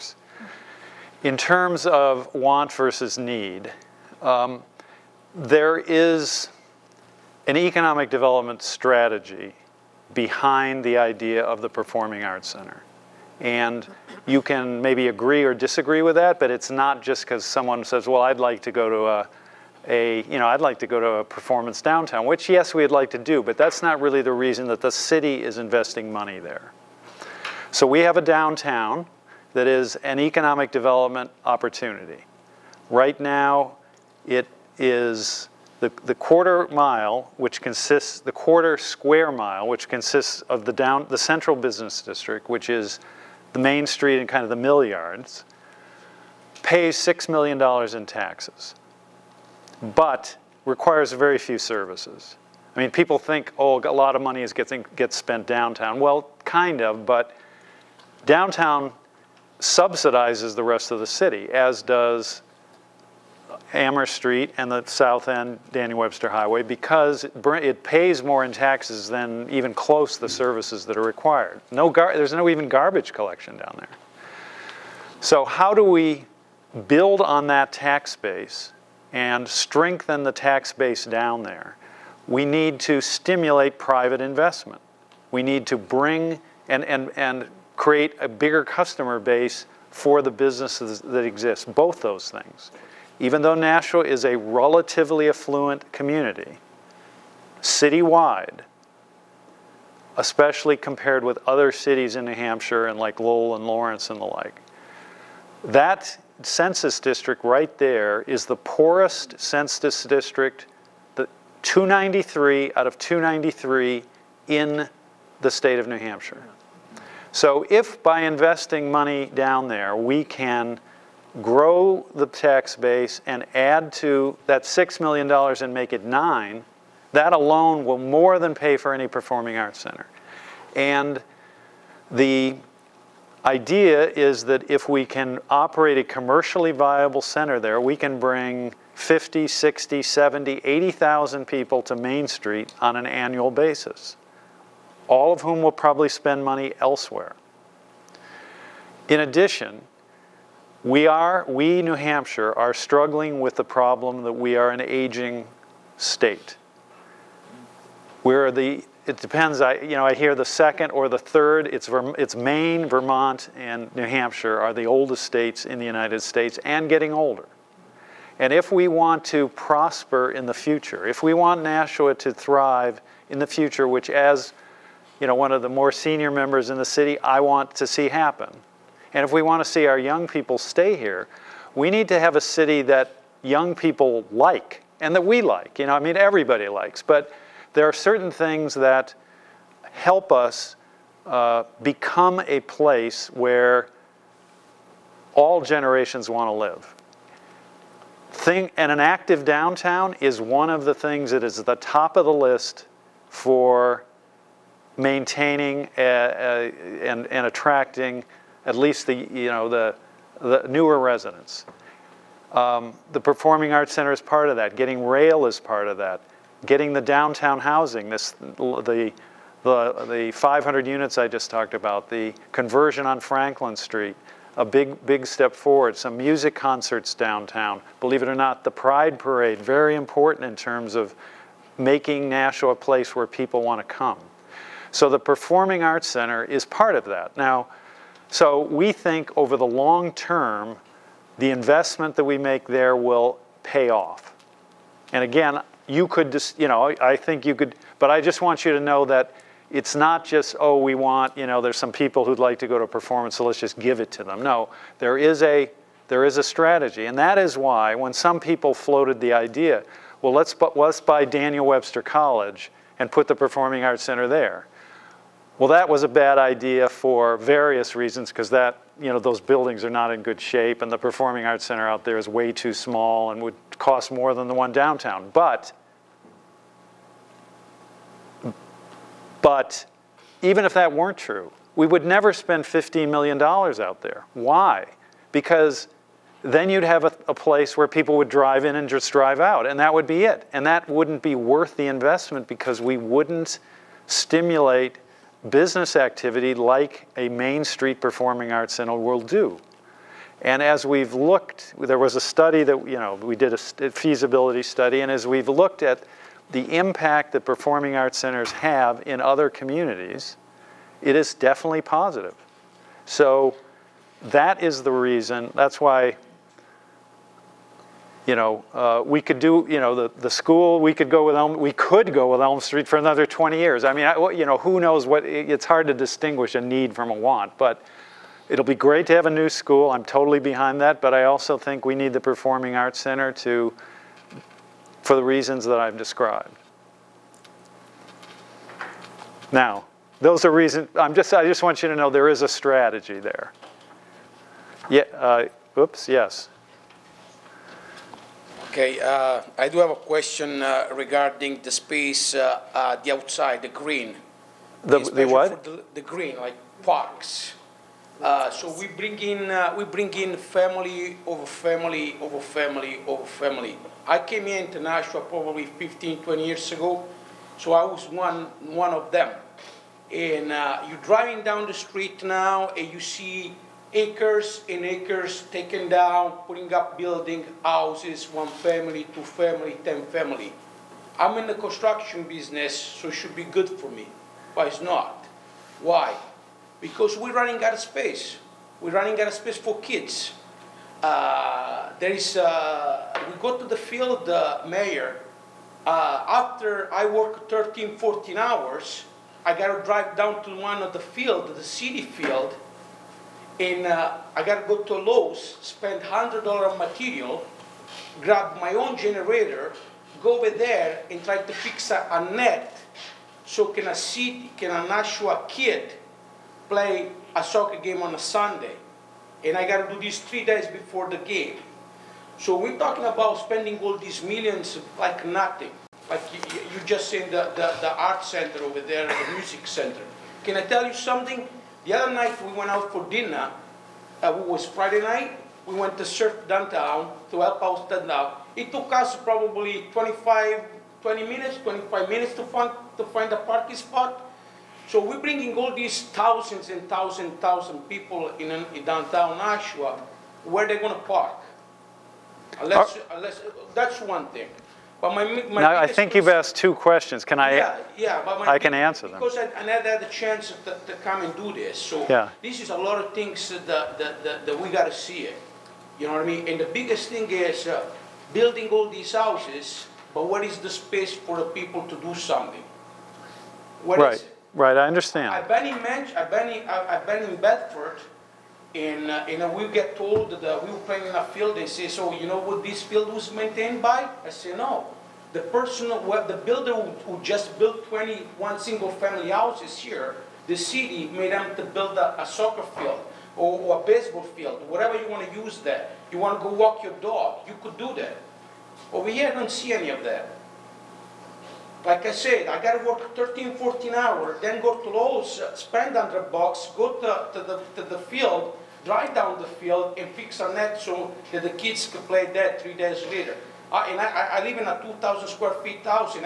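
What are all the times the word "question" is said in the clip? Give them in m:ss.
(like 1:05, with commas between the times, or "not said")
5:50, 7:36.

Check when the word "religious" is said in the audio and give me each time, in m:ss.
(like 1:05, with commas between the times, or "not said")
not said.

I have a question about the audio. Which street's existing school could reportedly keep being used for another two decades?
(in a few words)
Elm Street.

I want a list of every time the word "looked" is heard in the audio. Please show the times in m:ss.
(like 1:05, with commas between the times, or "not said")
5:01, 5:05.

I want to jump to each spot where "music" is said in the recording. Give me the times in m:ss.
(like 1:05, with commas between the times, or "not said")
3:46, 7:09.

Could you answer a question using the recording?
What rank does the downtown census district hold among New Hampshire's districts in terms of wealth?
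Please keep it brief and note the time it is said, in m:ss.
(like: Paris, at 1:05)
293 out of 293, at 1:51.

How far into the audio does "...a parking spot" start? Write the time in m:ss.
7:23.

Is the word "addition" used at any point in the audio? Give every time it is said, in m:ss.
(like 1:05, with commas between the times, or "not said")
2:29.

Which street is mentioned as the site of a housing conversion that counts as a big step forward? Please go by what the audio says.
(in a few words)
Franklin Street.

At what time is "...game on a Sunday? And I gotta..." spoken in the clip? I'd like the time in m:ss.
6:57.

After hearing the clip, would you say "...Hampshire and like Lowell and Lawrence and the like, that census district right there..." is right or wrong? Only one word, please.
right.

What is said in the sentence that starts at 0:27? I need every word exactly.
So we have a downtown that is an economic development opportunity.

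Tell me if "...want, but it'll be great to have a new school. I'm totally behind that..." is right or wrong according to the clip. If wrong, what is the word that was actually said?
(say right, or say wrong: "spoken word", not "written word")
right.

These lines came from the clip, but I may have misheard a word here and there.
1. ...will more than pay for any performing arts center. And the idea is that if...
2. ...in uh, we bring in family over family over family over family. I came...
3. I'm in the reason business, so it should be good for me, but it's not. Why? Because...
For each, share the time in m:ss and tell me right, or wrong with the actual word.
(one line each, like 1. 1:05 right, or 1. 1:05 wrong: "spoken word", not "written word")
1. 2:07 right
2. 5:59 right
3. 6:21 wrong: "construction", not "reason".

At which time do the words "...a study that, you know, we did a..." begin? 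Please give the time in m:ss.
5:02.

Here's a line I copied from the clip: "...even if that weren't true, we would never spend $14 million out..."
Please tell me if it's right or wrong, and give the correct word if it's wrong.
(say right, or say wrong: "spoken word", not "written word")
wrong: "15", not "14".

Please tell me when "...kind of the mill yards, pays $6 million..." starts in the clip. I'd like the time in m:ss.
0:44.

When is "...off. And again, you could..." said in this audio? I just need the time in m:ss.
4:03.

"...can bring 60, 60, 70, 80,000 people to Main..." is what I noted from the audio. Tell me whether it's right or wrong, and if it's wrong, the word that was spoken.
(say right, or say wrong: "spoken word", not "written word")
wrong: "50", not "60".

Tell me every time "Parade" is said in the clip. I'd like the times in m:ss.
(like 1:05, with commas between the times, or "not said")
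3:49.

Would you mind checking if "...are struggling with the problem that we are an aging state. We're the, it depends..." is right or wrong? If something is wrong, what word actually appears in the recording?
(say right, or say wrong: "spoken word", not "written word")
right.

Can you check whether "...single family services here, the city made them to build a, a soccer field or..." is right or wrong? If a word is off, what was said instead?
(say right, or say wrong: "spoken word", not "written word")
wrong: "houses", not "services".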